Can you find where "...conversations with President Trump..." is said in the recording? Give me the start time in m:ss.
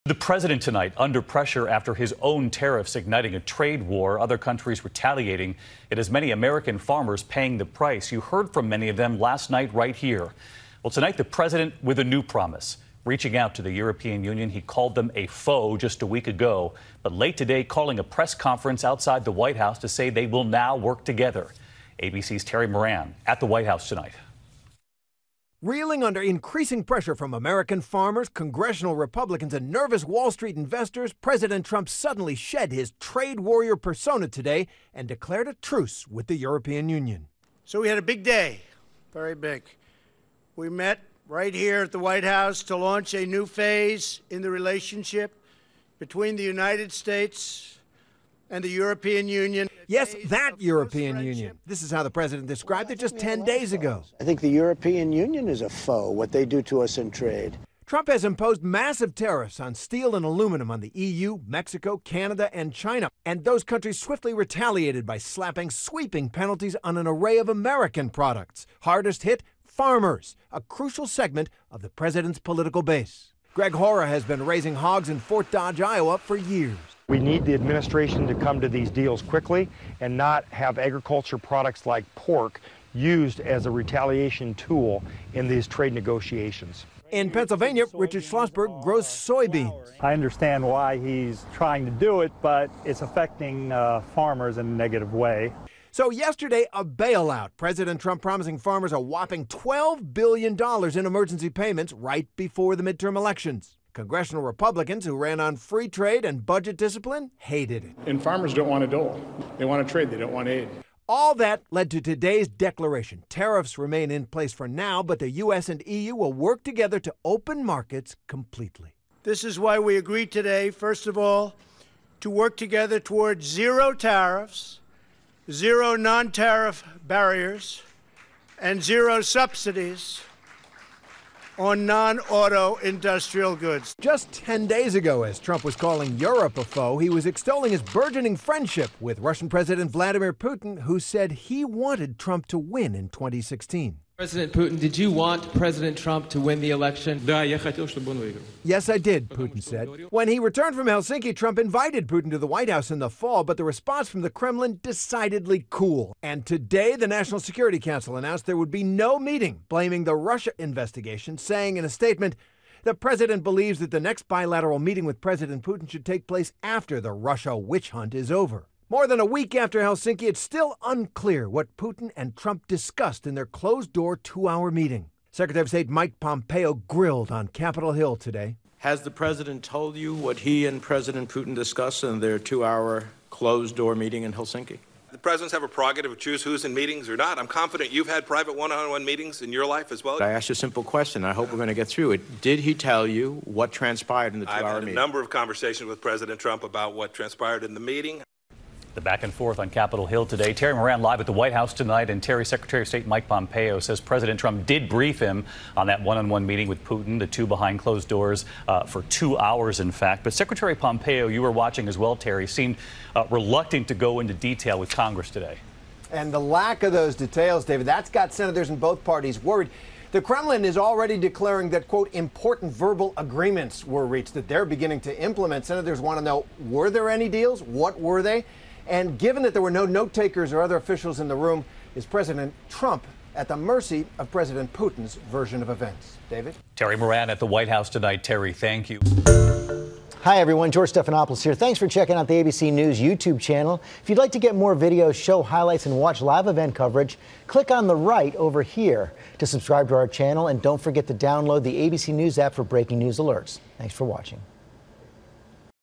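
3:15.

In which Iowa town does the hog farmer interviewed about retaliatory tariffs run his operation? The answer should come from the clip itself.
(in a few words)
Fort Dodge.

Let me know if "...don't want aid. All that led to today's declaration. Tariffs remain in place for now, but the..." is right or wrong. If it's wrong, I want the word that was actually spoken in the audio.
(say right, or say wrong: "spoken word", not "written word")
right.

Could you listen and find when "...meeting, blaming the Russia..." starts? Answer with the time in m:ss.
2:39.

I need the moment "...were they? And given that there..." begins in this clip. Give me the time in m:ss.
3:47.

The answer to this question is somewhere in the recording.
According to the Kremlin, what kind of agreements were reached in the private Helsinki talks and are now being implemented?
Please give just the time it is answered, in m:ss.
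3:42.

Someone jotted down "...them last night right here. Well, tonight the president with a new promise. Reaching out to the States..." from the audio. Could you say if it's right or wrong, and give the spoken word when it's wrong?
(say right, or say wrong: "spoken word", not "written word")
wrong: "European", not "States".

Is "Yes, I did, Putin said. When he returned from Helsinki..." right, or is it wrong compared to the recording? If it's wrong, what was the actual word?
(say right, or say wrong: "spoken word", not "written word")
right.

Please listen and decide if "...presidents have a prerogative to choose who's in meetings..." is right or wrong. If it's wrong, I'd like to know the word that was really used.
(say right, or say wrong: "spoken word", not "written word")
right.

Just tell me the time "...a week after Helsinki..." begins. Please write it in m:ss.
2:49.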